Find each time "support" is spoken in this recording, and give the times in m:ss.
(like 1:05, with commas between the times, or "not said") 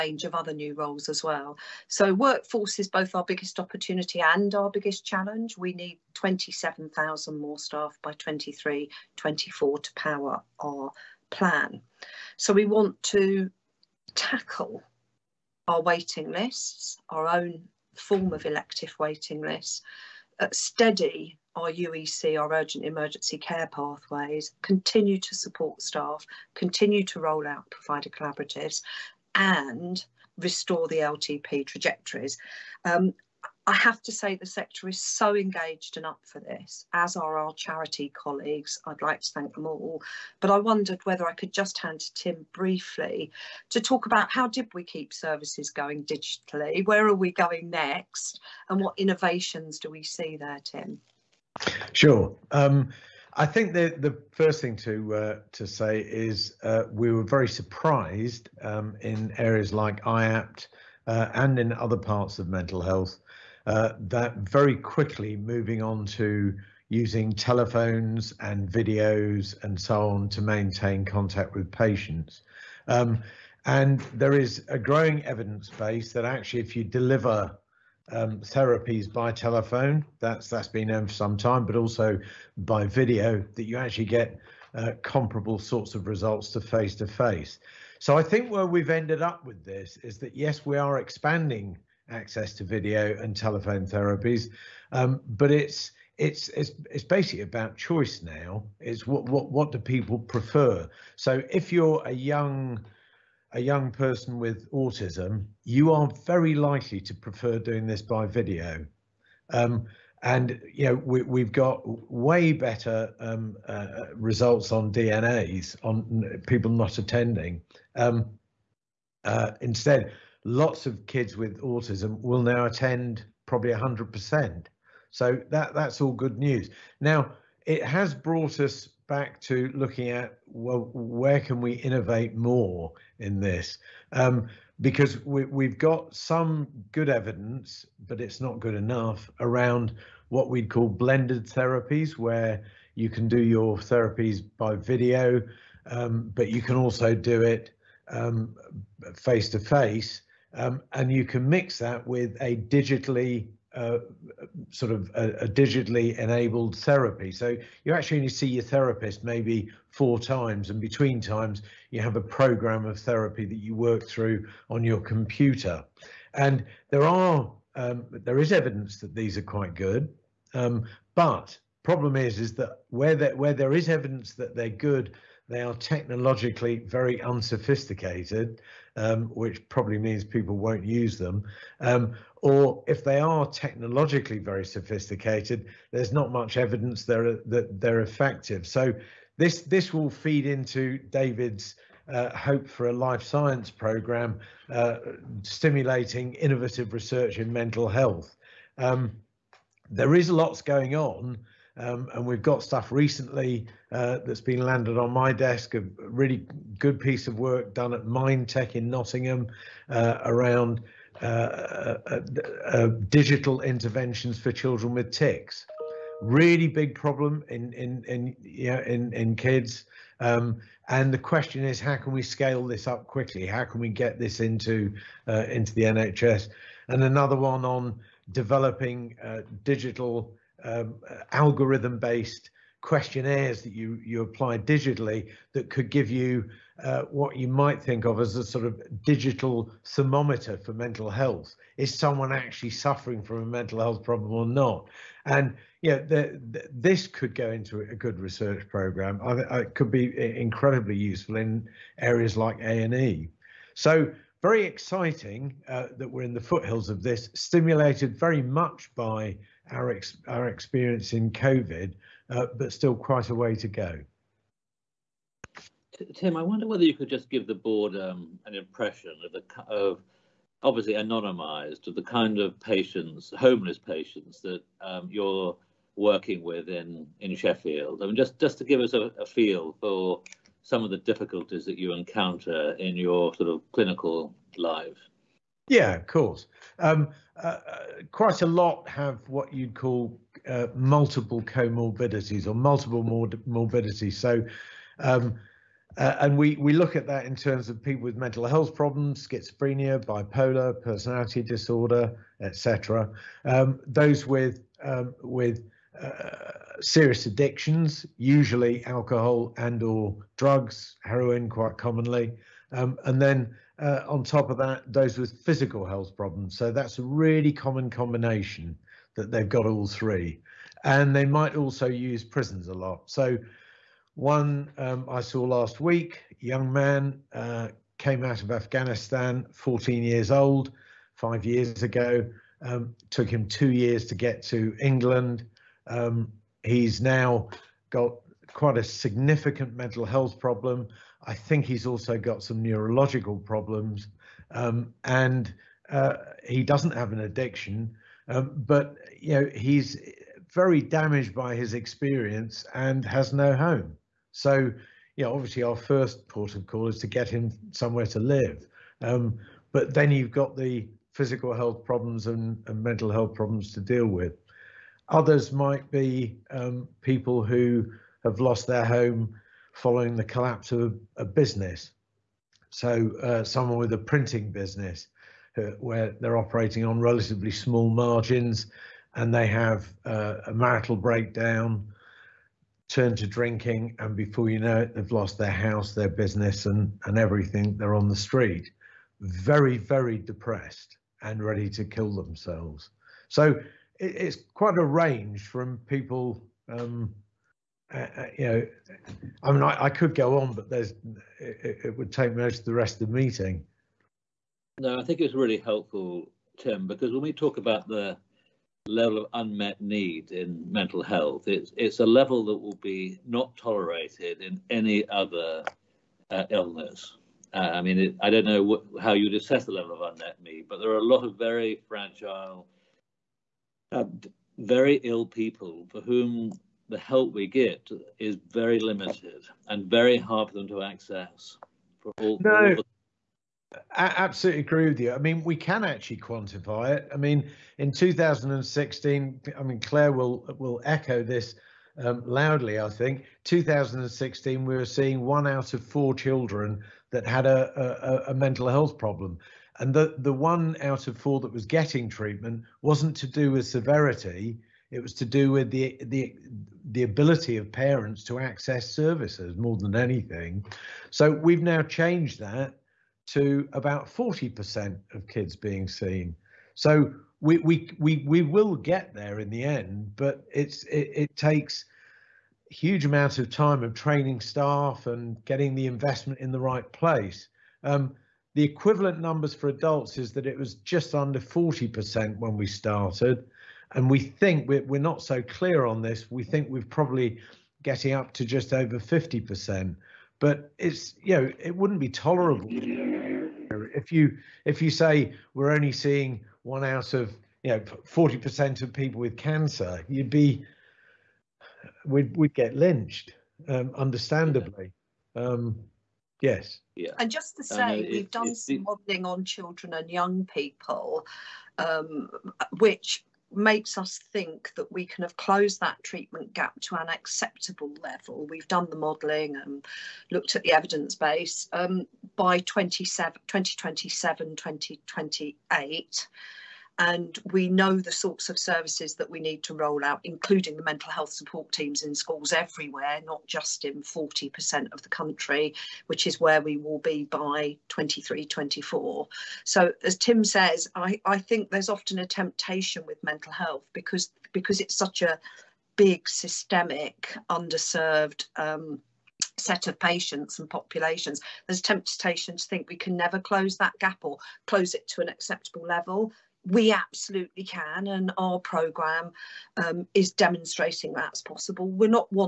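0:25, 8:51.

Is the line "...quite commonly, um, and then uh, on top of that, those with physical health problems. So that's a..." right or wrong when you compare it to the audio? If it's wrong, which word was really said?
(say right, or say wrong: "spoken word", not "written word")
right.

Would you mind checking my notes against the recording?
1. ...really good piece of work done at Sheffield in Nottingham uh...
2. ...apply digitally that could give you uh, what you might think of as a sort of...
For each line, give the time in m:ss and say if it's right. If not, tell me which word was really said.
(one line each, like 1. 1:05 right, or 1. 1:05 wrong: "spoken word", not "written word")
1. 3:25 wrong: "MindTech", not "Sheffield"
2. 3:54 right.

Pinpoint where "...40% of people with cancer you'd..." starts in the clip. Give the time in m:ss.
8:17.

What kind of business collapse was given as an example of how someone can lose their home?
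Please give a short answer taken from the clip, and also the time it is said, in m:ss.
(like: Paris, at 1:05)
printing business, at 6:13.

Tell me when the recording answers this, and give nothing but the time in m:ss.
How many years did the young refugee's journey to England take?
5:33.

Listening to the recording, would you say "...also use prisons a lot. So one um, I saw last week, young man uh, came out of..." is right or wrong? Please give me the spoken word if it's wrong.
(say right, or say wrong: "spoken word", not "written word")
right.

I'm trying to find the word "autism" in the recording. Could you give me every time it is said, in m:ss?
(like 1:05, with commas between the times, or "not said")
1:44, 2:01.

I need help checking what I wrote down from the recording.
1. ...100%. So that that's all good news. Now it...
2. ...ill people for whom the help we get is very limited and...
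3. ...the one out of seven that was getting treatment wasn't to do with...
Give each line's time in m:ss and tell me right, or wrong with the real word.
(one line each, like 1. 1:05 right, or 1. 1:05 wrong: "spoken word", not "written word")
1. 2:03 right
2. 7:05 right
3. 7:30 wrong: "four", not "seven".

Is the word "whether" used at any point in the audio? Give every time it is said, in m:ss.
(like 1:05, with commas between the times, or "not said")
0:41, 4:26.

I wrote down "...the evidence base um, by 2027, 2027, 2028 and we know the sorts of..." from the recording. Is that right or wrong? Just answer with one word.
right.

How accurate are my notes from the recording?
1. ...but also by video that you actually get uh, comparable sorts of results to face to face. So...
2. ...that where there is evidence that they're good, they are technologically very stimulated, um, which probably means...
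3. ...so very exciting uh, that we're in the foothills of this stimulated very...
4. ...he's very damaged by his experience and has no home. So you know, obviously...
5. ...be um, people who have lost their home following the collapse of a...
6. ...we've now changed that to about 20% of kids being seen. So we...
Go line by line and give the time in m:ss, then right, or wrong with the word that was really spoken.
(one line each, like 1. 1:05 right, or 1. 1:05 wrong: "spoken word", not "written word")
1. 1:21 right
2. 2:53 wrong: "unsophisticated", not "stimulated"
3. 4:13 right
4. 5:49 right
5. 6:05 right
6. 7:41 wrong: "40", not "20".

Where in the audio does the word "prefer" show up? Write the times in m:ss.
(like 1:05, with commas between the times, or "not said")
1:40, 1:47.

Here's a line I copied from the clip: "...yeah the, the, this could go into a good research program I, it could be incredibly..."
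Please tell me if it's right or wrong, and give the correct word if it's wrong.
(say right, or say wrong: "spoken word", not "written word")
right.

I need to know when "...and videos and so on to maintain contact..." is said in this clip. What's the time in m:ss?
1:08.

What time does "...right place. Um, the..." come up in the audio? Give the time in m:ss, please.
7:56.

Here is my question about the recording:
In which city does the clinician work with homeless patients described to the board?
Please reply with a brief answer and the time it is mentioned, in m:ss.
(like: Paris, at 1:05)
Sheffield, at 4:37.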